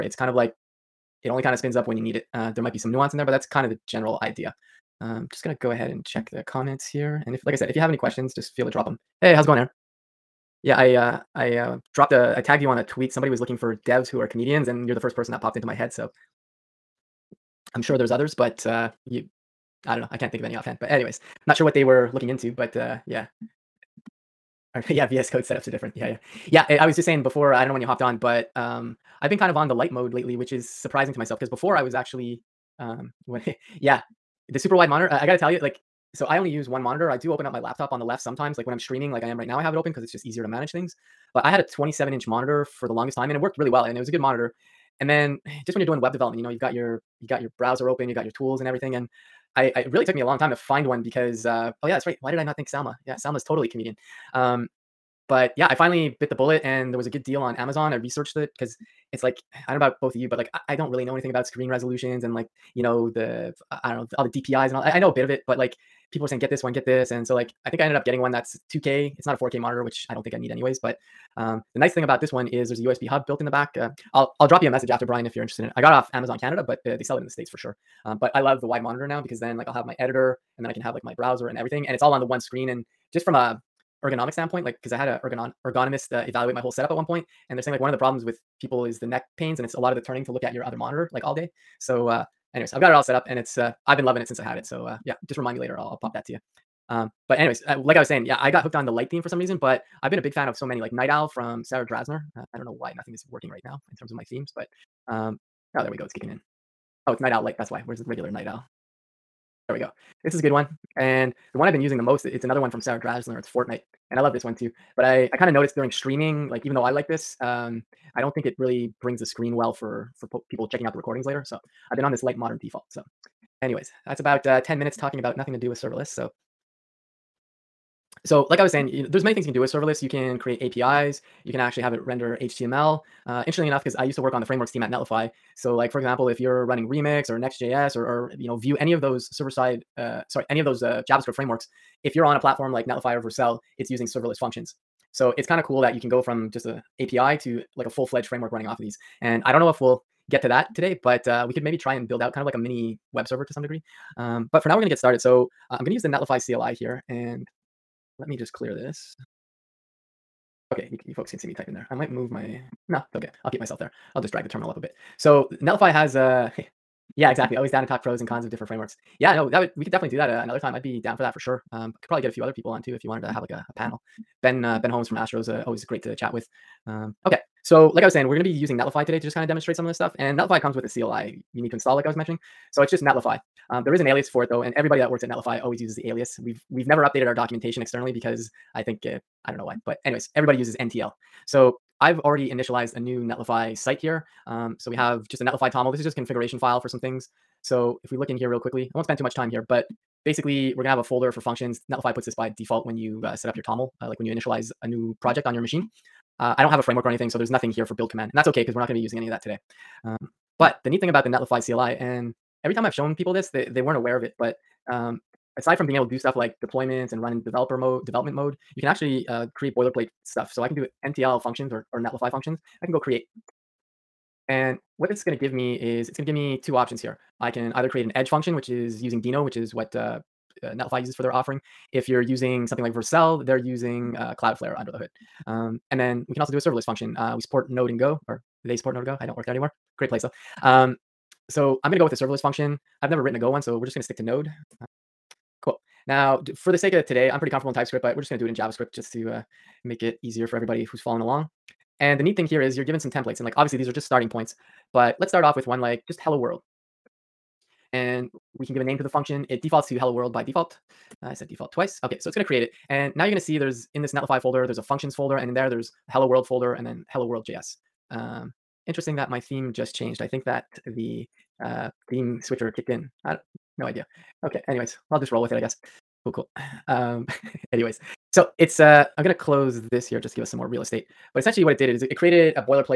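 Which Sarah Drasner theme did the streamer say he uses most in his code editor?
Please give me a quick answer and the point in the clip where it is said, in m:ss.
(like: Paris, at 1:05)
Fortnite, at 1:53.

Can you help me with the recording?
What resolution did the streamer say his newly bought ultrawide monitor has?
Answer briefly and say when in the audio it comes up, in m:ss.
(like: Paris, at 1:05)
2K, at 1:08.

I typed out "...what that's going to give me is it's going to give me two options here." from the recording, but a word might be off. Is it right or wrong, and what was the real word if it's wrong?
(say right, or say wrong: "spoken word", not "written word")
right.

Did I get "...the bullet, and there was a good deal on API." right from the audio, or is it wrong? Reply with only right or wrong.
wrong.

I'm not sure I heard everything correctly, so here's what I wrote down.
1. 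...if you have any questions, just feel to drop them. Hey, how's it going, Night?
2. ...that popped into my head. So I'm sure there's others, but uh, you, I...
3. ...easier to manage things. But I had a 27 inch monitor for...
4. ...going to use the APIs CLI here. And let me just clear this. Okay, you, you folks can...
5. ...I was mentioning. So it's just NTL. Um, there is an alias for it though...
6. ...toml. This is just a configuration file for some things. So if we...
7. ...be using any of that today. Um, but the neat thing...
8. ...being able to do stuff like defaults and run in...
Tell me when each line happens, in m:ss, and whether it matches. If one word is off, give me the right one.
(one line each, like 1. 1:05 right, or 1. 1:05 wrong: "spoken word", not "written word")
1. 0:07 wrong: "Aaron", not "Night"
2. 0:15 right
3. 0:40 right
4. 2:35 wrong: "Netlify", not "APIs"
5. 3:02 wrong: "Netlify", not "NTL"
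6. 3:15 right
7. 3:28 right
8. 3:35 wrong: "deployments", not "defaults".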